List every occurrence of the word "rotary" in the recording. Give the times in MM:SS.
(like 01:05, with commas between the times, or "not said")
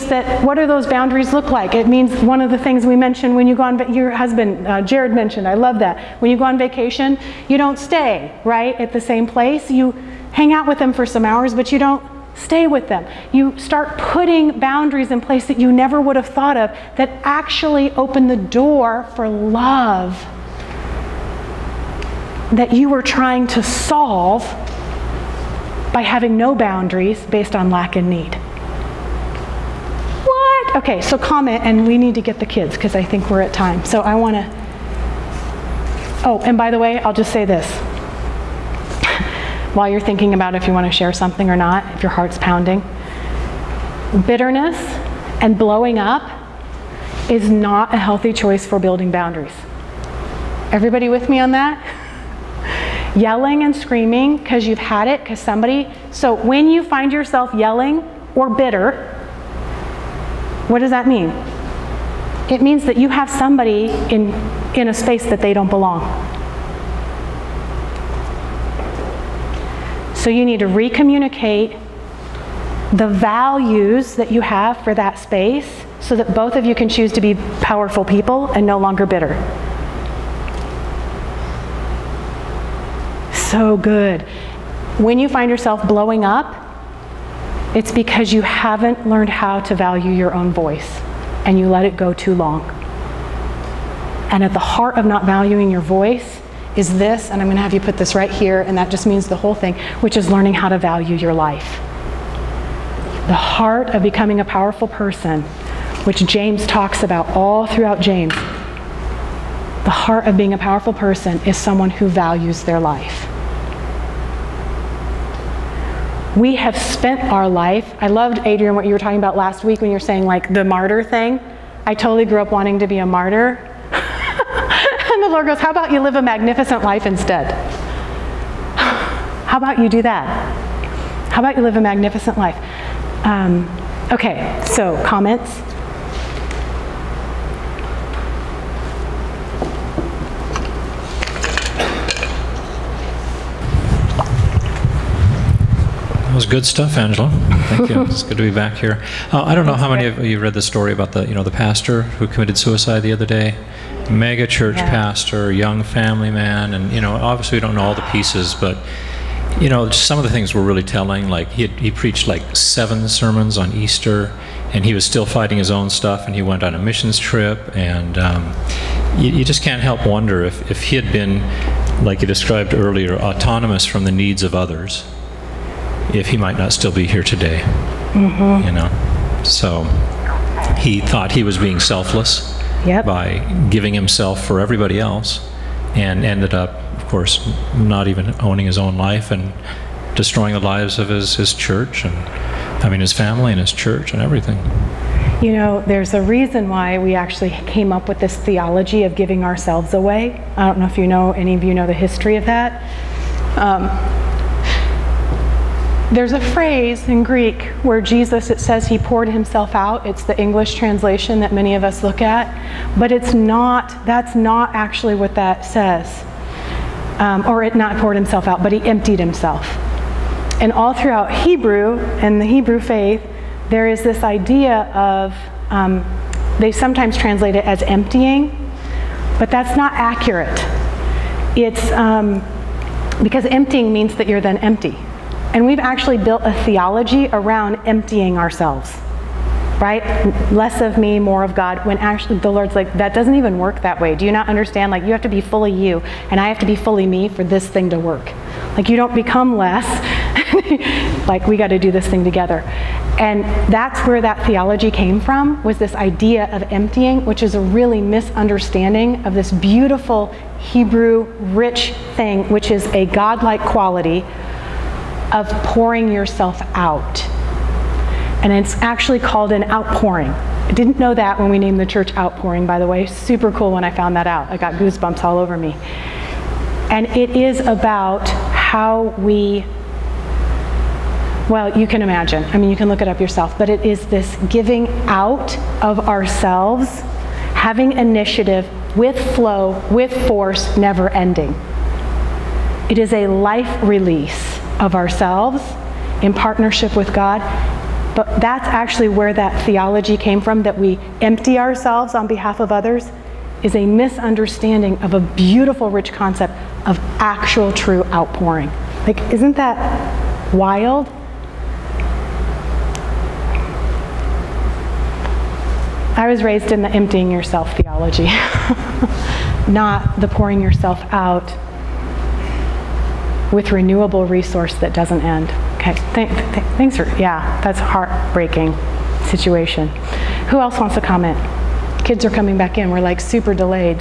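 not said.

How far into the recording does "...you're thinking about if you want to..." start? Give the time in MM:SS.
00:39.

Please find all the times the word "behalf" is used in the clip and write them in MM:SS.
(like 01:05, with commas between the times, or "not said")
05:02.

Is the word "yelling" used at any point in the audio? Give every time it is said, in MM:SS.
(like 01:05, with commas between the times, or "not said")
00:53, 00:57.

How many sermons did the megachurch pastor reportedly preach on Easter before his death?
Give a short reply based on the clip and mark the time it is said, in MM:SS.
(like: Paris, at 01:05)
7, at 02:42.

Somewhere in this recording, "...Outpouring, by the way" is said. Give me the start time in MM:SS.
04:32.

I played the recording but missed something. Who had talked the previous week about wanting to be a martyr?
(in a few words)
Adrian.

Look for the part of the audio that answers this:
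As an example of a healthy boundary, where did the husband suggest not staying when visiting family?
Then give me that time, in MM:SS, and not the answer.
00:08.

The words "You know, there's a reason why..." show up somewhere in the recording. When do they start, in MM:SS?
03:15.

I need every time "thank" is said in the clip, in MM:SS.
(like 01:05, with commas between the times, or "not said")
02:27, 05:26.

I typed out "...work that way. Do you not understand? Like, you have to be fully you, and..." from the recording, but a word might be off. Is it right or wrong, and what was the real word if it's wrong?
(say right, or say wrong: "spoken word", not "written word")
right.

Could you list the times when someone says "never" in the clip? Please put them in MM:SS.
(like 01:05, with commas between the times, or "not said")
00:15, 04:50.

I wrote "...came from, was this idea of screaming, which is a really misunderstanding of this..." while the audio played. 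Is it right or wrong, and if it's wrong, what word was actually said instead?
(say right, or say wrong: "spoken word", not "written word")
wrong: "emptying", not "screaming".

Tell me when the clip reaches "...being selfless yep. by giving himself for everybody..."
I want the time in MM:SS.
03:01.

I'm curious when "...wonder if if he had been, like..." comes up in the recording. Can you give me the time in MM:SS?
02:50.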